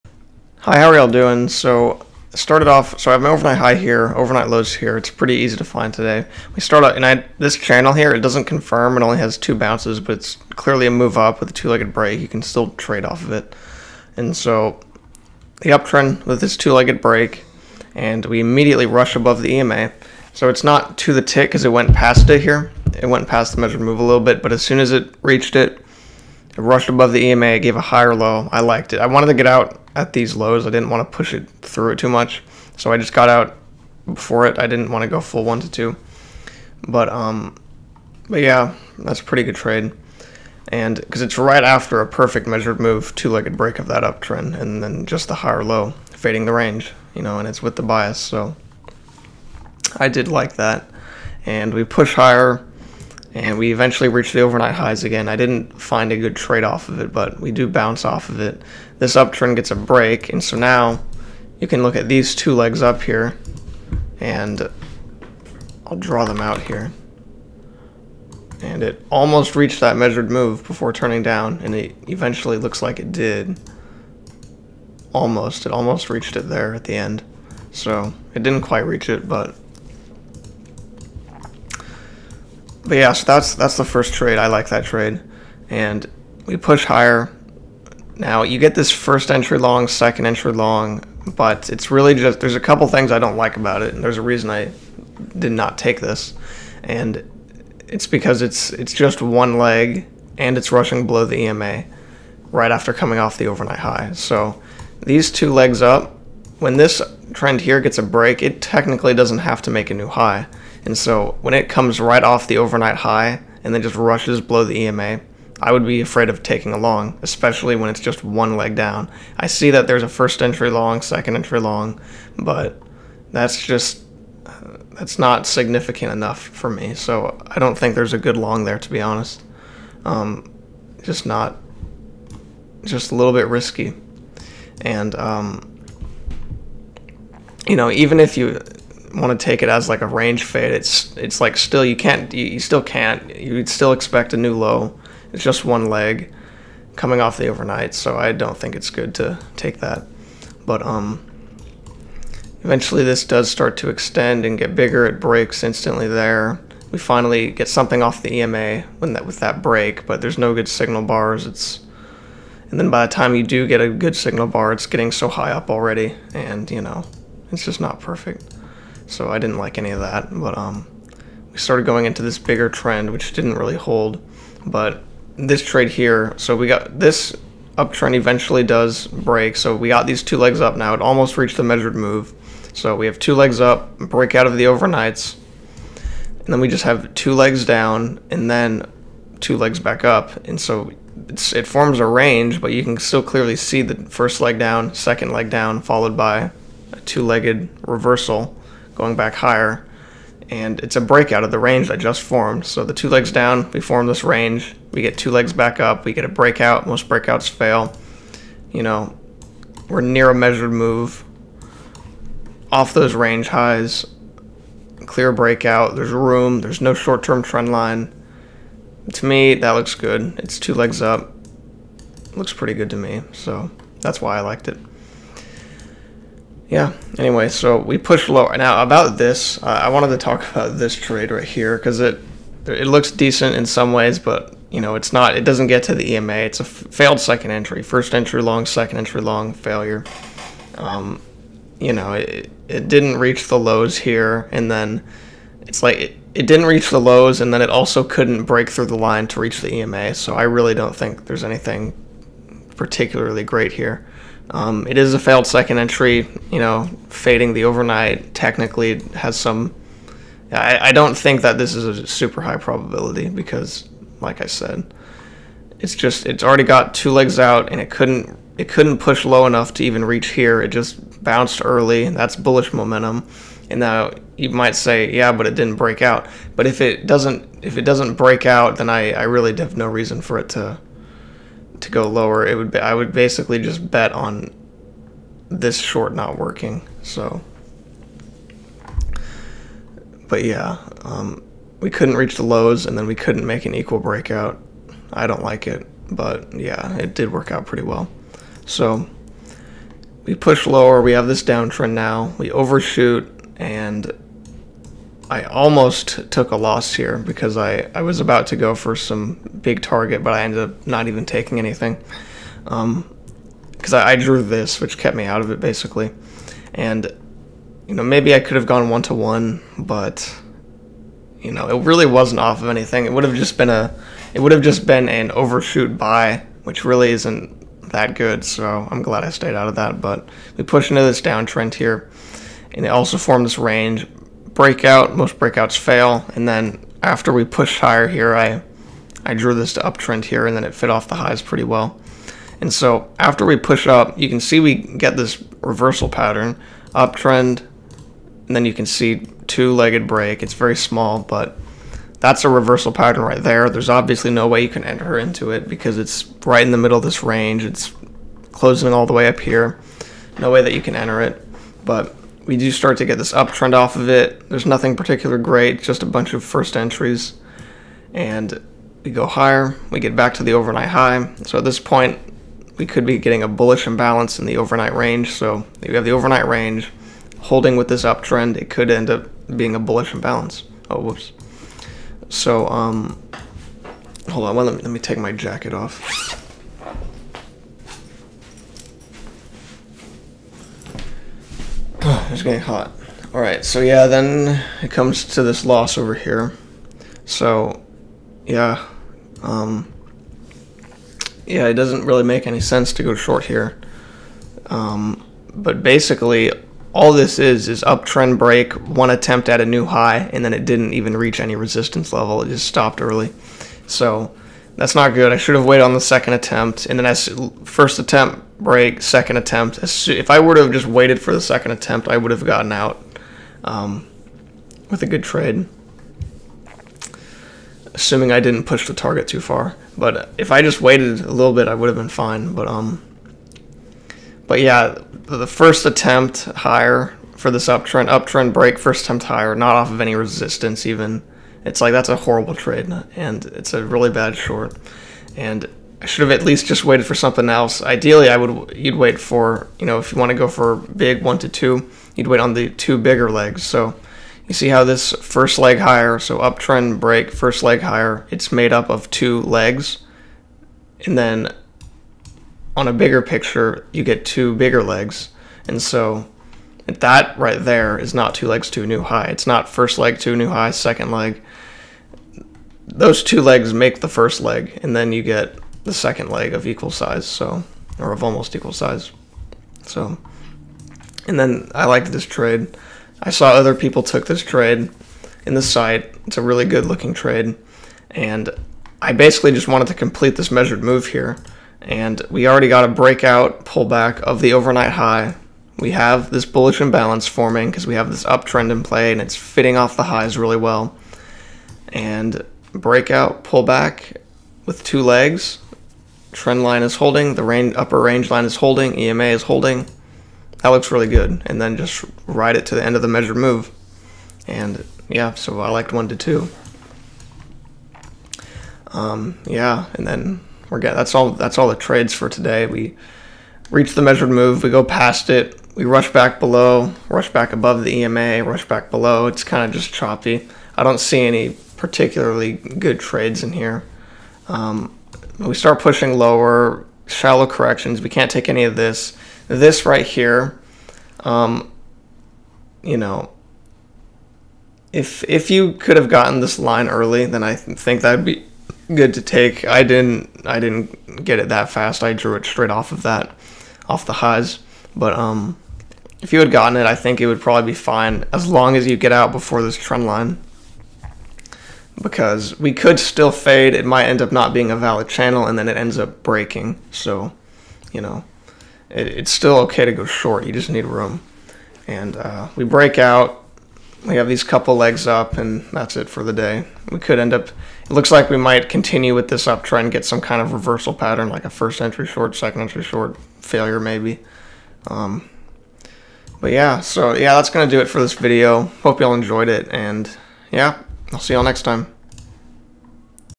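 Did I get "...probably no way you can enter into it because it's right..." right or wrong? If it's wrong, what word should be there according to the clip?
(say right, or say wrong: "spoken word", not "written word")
wrong: "obviously", not "probably".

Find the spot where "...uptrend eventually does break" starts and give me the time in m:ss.
2:57.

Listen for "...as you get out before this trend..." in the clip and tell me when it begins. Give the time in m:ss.
9:18.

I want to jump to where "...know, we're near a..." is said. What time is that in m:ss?
3:28.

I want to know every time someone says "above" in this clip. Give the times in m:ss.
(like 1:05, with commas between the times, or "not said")
0:19, 0:26, 8:47.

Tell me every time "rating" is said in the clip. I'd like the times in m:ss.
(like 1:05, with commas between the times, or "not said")
not said.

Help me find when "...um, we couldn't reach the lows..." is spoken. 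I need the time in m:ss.
4:51.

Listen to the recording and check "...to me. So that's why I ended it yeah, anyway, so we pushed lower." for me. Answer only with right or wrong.
wrong.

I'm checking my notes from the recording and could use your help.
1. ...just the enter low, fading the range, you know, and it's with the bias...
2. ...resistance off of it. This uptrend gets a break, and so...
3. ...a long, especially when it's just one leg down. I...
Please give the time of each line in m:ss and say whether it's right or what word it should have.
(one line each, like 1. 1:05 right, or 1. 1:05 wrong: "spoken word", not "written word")
1. 0:45 wrong: "higher", not "enter"
2. 0:57 wrong: "bounce", not "resistance"
3. 1:56 right.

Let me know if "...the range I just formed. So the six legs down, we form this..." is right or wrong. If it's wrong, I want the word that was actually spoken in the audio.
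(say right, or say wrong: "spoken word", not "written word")
wrong: "two", not "six".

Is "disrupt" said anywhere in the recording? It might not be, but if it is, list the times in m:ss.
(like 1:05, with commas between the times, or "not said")
not said.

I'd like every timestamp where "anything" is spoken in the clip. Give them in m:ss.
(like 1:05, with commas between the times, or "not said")
4:11, 5:11, 5:22.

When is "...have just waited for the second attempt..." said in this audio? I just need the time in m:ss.
7:00.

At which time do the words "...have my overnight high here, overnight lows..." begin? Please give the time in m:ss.
0:03.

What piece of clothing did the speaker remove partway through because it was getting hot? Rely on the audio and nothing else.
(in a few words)
Jacket.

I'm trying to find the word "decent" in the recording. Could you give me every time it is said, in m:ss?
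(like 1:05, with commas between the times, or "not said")
3:53.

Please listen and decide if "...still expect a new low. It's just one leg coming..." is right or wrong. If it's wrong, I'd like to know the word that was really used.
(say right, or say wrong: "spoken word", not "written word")
right.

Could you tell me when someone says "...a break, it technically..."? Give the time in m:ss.
1:47.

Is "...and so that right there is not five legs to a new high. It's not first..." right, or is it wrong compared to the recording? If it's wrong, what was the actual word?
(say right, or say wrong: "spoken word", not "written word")
wrong: "two", not "five".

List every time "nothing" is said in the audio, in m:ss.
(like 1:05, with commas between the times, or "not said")
6:04.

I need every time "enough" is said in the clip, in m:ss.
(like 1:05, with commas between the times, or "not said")
2:06, 4:29.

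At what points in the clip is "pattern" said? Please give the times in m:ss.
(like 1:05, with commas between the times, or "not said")
5:46, 5:52, 9:40.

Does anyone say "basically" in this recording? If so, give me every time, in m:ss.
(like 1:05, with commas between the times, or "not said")
4:43, 5:15, 6:45, 8:09.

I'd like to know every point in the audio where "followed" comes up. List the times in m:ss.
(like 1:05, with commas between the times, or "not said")
3:15.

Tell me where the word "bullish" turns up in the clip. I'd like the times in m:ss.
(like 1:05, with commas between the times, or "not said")
4:32, 6:13, 6:19, 8:16.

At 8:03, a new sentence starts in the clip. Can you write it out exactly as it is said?
I saw other people took this trade in the site.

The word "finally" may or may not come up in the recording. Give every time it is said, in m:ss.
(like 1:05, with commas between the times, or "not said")
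2:36.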